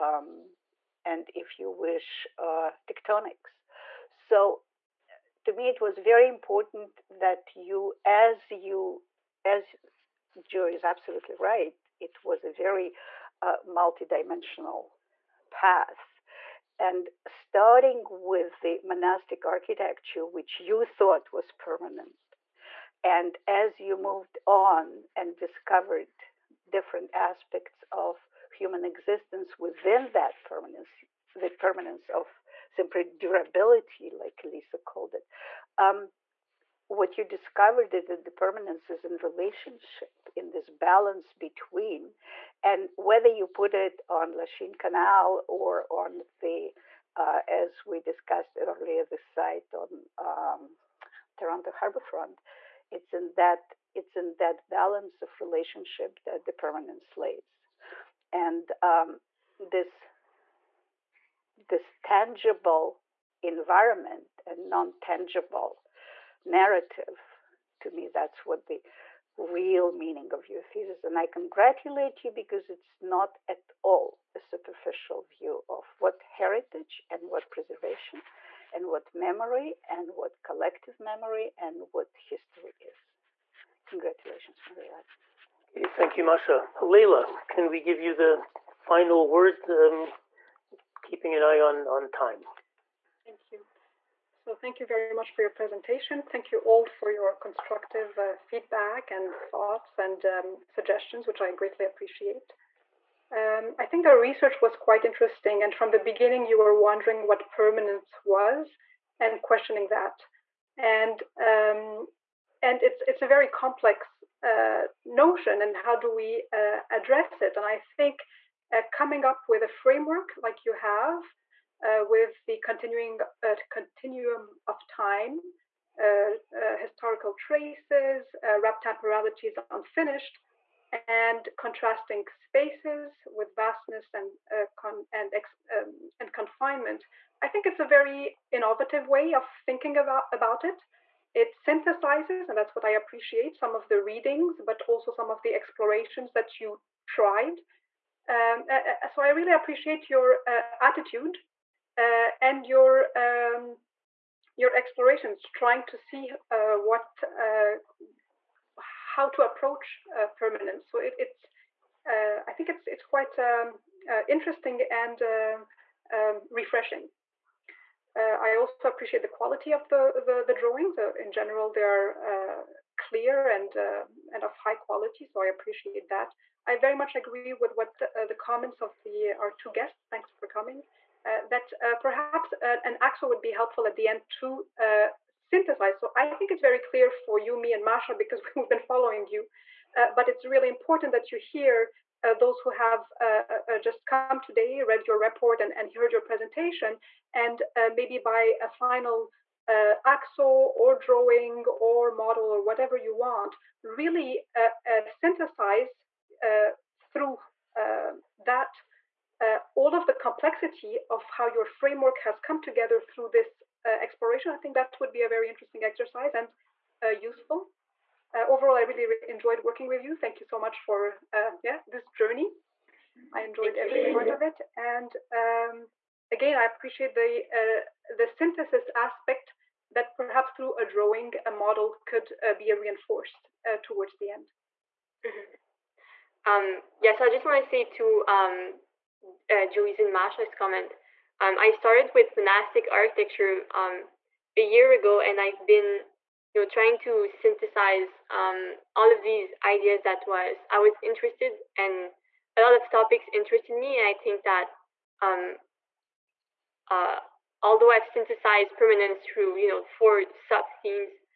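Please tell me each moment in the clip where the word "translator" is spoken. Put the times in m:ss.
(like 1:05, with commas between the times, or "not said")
not said.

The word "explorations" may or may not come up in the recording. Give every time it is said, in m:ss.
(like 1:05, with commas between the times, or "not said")
2:25, 2:34, 3:33.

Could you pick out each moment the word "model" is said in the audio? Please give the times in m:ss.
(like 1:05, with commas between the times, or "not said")
3:22, 3:51.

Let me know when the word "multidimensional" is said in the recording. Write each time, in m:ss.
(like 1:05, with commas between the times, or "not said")
0:13.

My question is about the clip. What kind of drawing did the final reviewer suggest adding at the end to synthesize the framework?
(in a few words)
An axo.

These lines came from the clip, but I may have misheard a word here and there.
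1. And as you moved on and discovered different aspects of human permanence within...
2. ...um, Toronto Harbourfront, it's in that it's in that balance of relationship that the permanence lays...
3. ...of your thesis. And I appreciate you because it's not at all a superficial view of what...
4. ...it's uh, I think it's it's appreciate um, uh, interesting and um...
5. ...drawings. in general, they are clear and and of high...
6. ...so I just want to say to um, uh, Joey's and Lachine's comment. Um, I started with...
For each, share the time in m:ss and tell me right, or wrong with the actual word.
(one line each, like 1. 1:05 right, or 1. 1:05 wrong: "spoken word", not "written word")
1. 0:23 wrong: "existence", not "permanence"
2. 0:50 right
3. 1:10 wrong: "congratulate", not "appreciate"
4. 2:41 wrong: "quite", not "appreciate"
5. 2:50 right
6. 3:57 wrong: "Masha", not "Lachine".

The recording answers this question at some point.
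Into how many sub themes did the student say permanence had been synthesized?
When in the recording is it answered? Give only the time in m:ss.
4:19.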